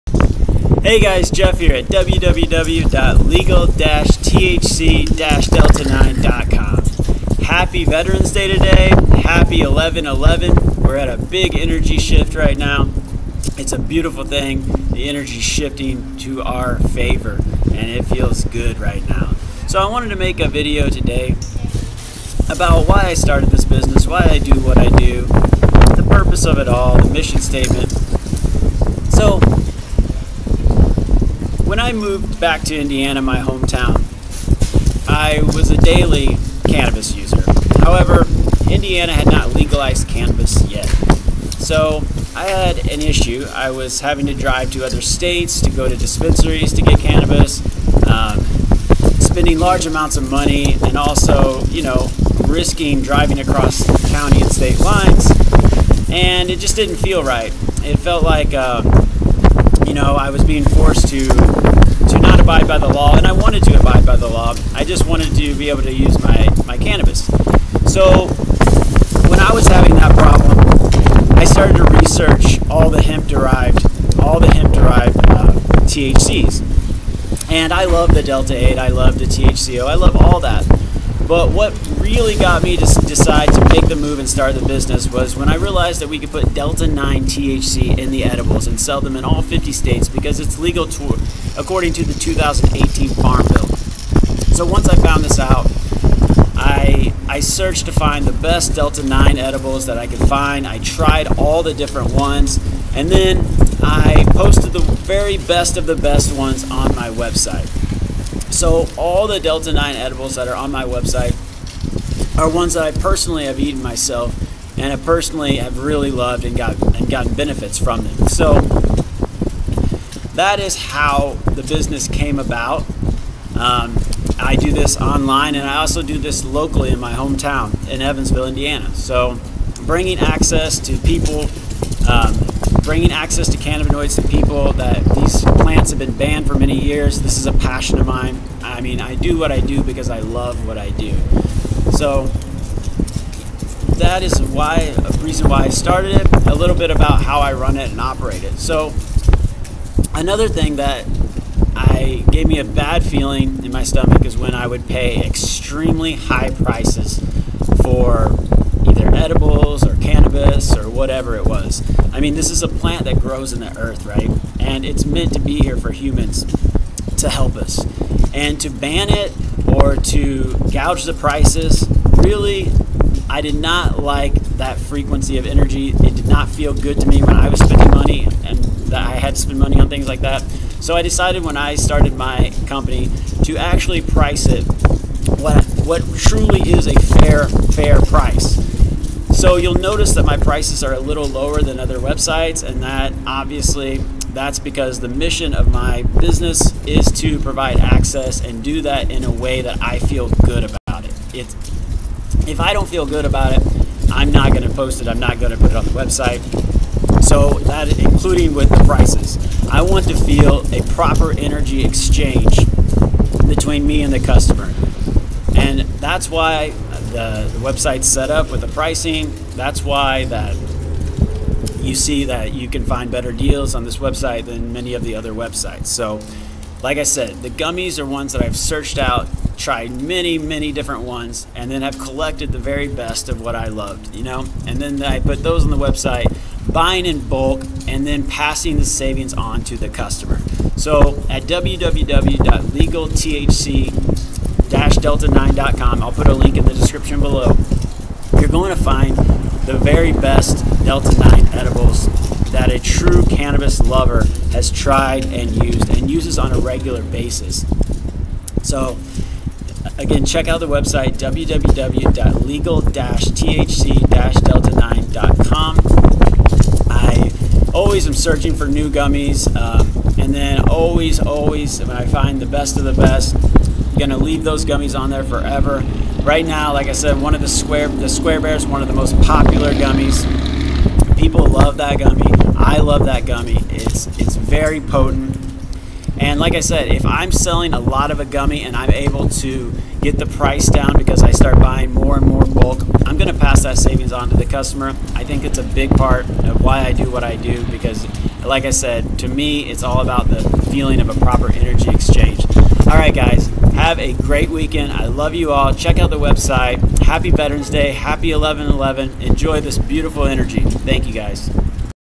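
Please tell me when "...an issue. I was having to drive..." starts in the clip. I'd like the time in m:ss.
0:42.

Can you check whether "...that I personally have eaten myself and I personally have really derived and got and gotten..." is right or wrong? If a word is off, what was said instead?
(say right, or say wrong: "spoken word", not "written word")
wrong: "loved", not "derived".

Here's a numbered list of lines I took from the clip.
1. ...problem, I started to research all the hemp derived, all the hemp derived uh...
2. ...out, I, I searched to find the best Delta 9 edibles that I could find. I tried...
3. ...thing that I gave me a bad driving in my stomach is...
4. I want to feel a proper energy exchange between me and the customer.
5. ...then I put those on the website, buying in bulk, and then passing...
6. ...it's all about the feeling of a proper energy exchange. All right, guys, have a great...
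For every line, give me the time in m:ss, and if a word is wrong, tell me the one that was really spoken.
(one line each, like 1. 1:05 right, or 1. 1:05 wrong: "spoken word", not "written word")
1. 1:10 right
2. 1:35 right
3. 2:30 wrong: "feeling", not "driving"
4. 3:29 right
5. 3:54 right
6. 4:59 right.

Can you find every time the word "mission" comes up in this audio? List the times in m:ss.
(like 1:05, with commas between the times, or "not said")
0:27, 3:15.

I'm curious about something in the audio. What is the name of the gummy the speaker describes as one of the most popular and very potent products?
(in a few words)
Square Bear.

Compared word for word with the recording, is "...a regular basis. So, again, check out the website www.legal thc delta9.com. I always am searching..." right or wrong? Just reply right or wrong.
right.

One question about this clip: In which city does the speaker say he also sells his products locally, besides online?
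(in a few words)
Evansville.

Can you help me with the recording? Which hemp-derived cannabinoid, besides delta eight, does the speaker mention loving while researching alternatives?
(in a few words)
THCO.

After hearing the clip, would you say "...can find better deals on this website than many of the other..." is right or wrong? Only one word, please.
right.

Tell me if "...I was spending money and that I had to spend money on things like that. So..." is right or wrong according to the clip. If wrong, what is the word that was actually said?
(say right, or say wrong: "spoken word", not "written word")
right.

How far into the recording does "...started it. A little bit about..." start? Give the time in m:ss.
2:25.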